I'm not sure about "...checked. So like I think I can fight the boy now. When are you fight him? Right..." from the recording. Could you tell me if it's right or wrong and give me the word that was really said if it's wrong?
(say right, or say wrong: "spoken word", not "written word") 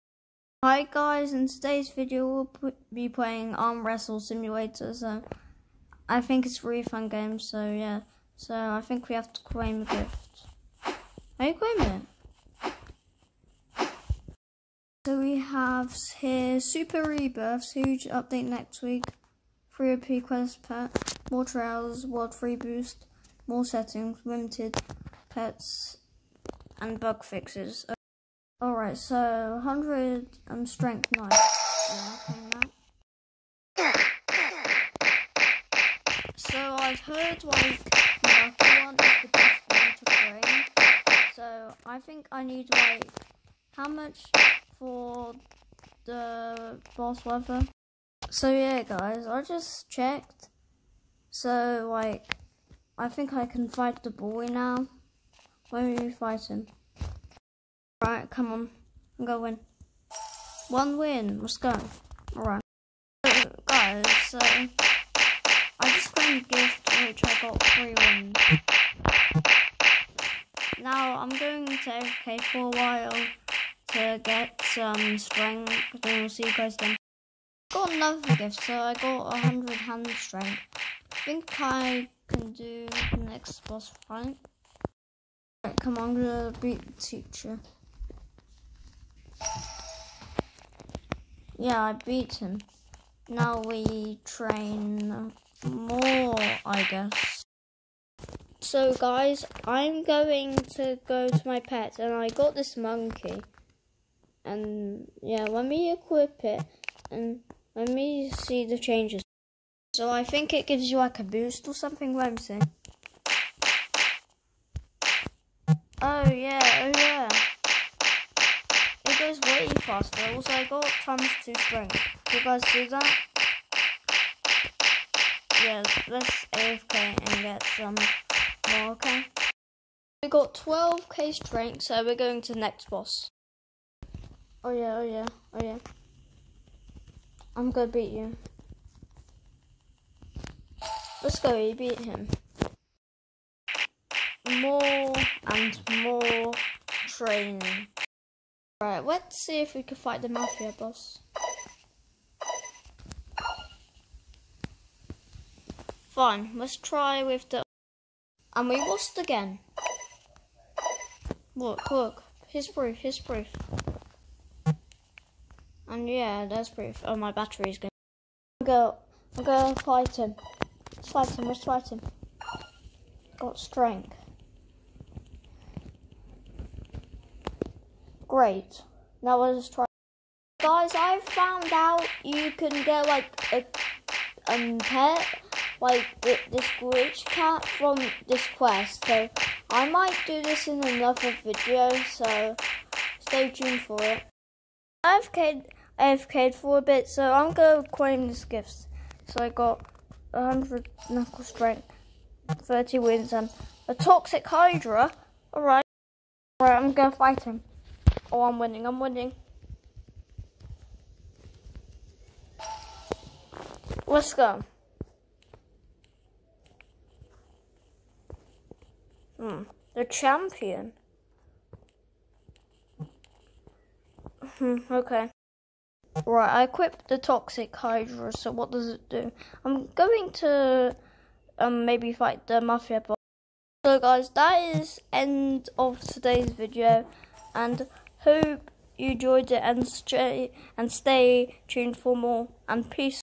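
right.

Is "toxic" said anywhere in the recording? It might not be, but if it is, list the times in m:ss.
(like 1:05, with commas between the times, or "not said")
3:23, 3:47.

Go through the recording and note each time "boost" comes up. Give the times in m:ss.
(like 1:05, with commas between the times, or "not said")
0:22, 1:51.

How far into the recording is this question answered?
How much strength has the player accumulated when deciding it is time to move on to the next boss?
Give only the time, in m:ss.
2:10.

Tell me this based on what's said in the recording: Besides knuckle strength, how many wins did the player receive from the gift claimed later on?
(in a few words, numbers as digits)
30.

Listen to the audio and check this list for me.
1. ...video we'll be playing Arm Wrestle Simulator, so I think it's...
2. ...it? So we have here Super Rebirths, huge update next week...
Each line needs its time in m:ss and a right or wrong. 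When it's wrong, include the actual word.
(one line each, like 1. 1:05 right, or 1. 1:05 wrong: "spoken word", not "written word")
1. 0:01 right
2. 0:13 right.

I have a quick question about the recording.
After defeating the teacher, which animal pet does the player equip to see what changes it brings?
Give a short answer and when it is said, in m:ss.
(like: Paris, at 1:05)
monkey, at 1:42.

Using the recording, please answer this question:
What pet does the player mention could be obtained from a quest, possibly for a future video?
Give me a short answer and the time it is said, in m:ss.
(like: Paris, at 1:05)
glitch cat, at 3:06.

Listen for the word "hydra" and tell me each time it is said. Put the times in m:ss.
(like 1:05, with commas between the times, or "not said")
3:24, 3:47.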